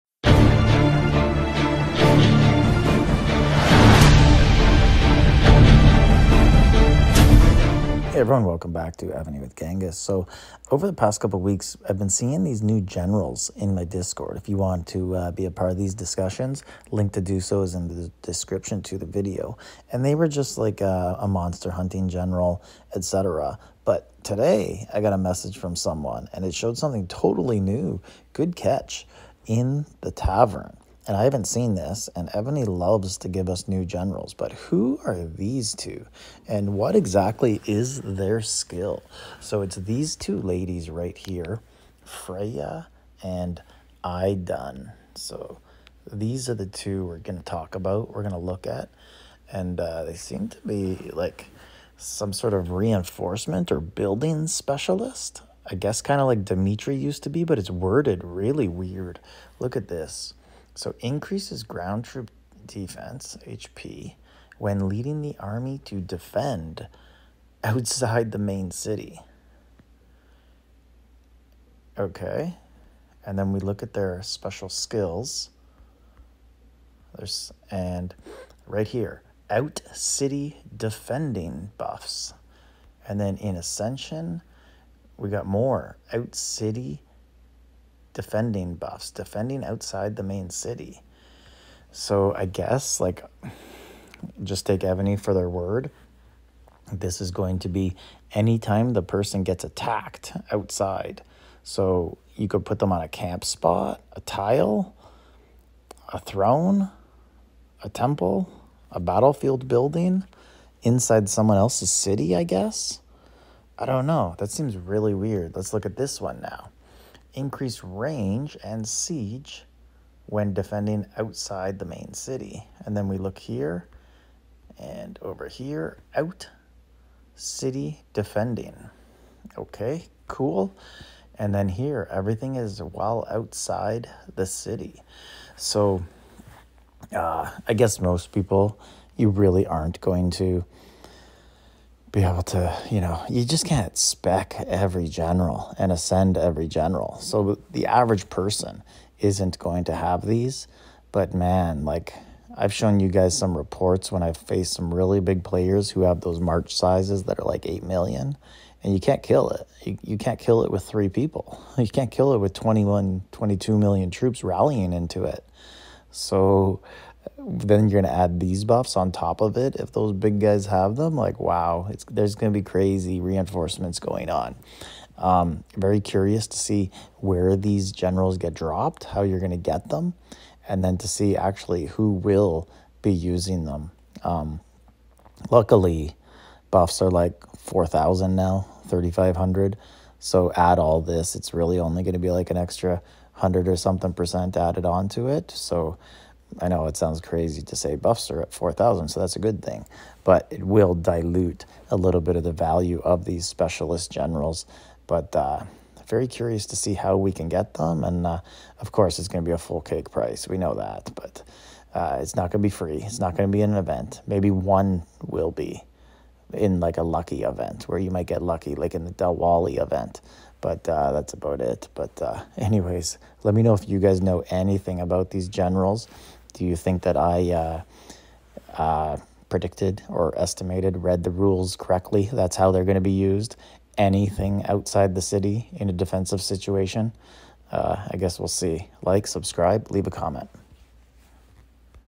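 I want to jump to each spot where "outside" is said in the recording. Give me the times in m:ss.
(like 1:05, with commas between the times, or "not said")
1:07, 1:29, 1:40, 2:01, 2:13, 3:54.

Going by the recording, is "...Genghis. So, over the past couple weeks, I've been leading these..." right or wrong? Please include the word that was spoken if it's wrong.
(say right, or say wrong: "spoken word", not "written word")
wrong: "seeing", not "leading".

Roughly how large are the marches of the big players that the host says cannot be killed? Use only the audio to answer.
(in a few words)
8 million.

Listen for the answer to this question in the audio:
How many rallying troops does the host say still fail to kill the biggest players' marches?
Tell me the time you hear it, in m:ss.
2:42.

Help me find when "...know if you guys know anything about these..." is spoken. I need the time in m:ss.
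3:43.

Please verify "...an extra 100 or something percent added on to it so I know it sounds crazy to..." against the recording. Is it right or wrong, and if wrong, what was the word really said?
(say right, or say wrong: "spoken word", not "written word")
right.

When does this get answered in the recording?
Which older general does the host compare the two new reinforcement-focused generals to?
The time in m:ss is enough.
0:56.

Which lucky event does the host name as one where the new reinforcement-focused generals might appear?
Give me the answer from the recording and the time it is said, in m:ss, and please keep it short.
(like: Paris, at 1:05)
Dalwali event, at 3:39.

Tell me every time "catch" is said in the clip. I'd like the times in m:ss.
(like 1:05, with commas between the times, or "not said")
0:28.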